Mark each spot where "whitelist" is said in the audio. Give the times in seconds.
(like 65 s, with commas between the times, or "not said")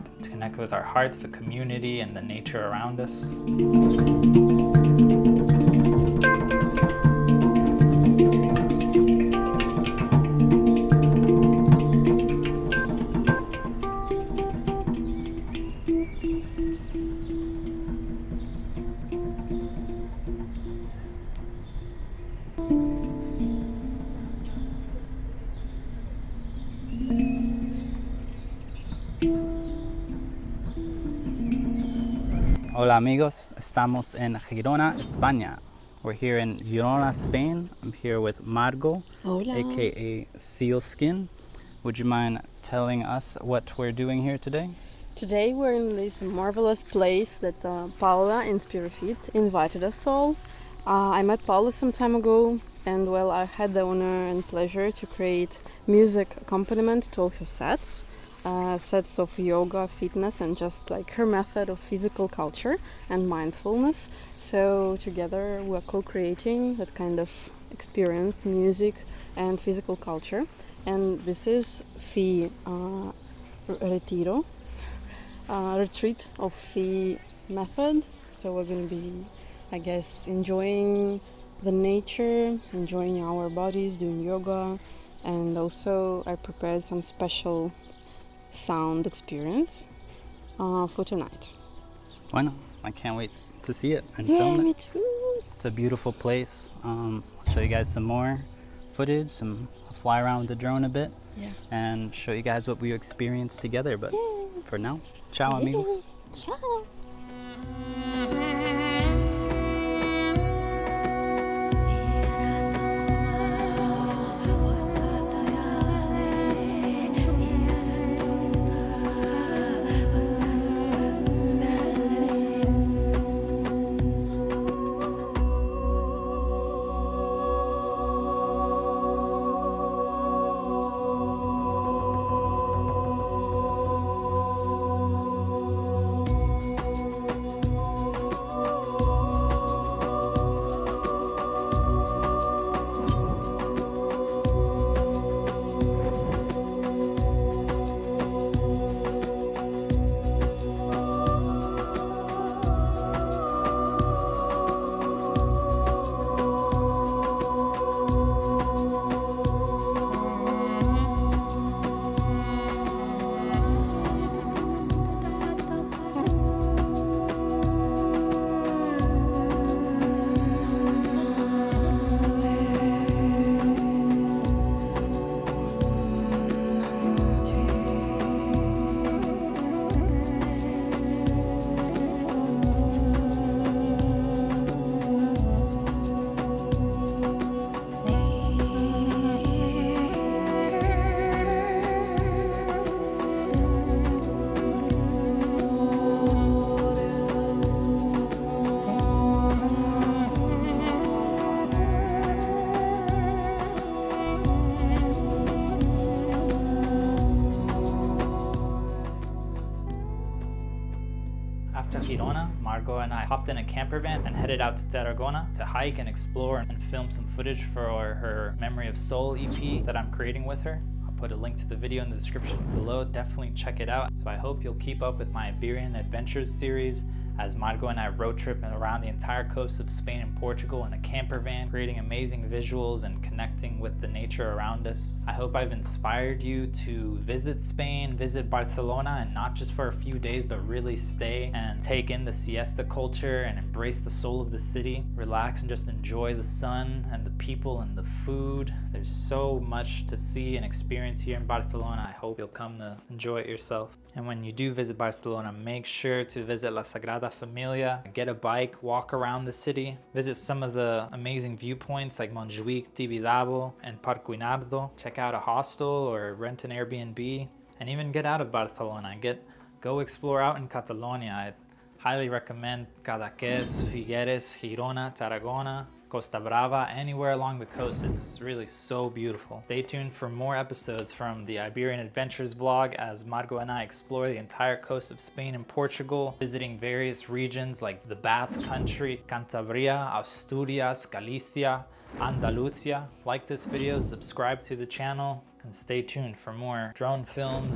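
not said.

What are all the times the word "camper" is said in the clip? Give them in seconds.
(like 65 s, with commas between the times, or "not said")
213 s, 230 s.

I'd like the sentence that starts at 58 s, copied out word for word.
Uh, sets of yoga, fitness, and just like her method of physical culture and mindfulness.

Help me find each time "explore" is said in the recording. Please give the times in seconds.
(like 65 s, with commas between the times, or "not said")
216 s, 270 s, 283 s.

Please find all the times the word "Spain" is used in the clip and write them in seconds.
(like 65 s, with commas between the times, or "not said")
37 s, 229 s, 237 s, 285 s.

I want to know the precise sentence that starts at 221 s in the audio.
I'll put a link to the video in the description below.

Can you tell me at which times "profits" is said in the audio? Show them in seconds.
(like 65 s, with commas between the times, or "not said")
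not said.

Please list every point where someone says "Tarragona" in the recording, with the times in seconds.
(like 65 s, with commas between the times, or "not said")
214 s, 275 s.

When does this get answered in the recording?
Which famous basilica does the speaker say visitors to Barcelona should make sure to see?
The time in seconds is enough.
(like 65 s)
256 s.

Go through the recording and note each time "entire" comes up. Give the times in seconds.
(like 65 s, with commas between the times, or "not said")
229 s, 284 s.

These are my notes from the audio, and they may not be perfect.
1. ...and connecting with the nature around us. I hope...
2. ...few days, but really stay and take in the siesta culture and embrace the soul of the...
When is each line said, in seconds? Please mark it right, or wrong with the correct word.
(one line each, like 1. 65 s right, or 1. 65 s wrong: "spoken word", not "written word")
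1. 233 s right
2. 239 s right.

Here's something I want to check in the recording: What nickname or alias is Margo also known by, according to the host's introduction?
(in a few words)
Sealskin.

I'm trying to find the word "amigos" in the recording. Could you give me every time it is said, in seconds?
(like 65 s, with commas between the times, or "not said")
32 s, 105 s.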